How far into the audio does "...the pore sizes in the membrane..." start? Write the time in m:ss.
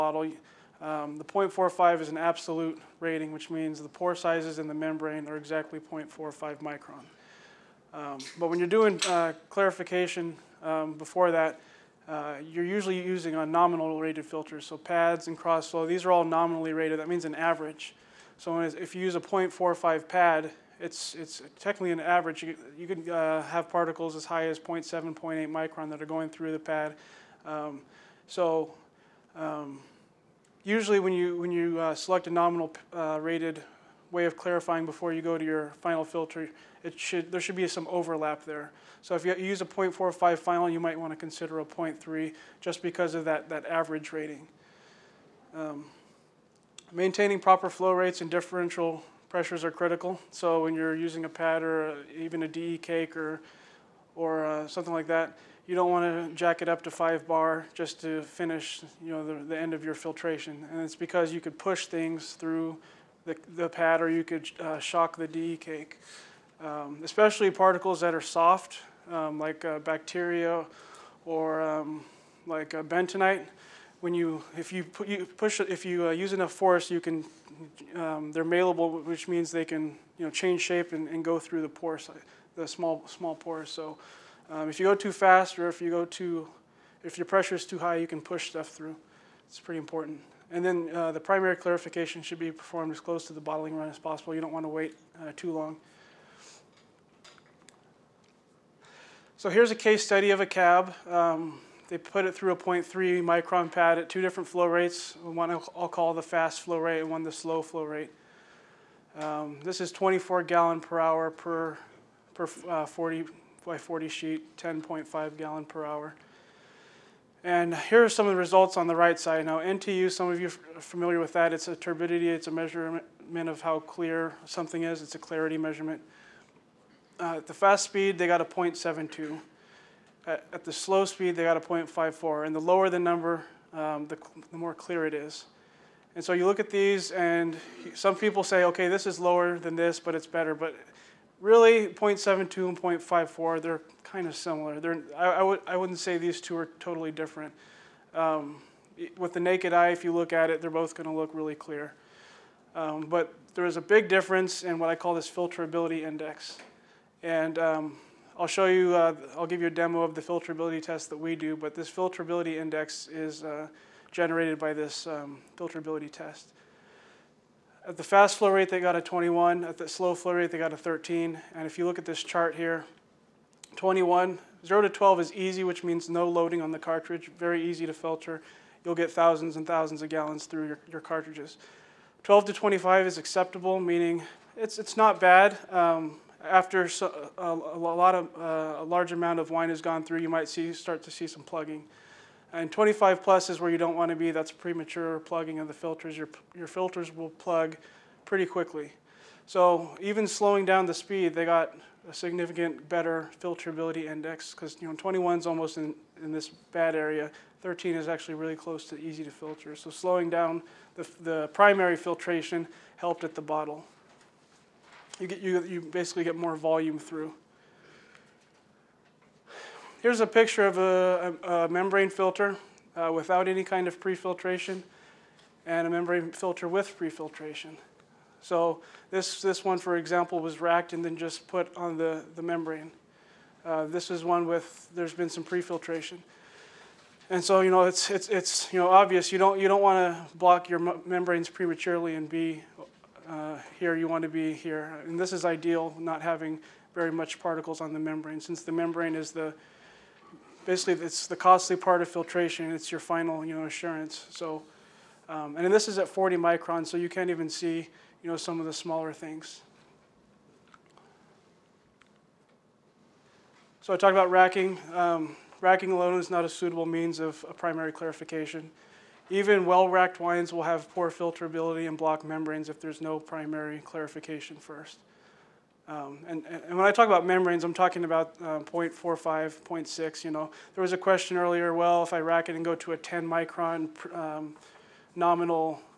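0:03.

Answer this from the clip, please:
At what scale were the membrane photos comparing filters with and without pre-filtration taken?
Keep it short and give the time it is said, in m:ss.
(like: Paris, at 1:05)
40 microns, at 4:16.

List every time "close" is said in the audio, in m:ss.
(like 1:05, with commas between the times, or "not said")
1:32, 3:28.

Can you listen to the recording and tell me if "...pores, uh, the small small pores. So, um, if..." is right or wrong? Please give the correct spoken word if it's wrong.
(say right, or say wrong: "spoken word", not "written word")
right.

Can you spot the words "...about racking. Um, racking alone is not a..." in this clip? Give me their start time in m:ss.
4:24.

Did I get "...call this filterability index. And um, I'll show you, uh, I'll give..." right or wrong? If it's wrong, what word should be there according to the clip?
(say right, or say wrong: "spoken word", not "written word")
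right.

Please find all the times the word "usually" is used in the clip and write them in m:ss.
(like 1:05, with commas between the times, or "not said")
0:12, 0:30.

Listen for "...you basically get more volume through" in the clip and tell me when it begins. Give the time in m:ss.
3:35.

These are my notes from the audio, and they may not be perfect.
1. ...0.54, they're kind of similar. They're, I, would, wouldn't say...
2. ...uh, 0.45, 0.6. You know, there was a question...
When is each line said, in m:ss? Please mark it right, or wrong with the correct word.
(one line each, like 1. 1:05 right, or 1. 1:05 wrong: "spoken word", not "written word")
1. 2:22 right
2. 4:38 right.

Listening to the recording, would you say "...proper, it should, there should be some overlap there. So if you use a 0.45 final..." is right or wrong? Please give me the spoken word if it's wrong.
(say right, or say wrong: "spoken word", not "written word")
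wrong: "filter", not "proper".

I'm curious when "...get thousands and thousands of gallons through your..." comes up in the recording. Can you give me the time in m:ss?
2:58.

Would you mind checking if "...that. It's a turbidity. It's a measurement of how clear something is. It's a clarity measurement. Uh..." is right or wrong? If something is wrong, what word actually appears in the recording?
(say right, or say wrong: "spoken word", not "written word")
right.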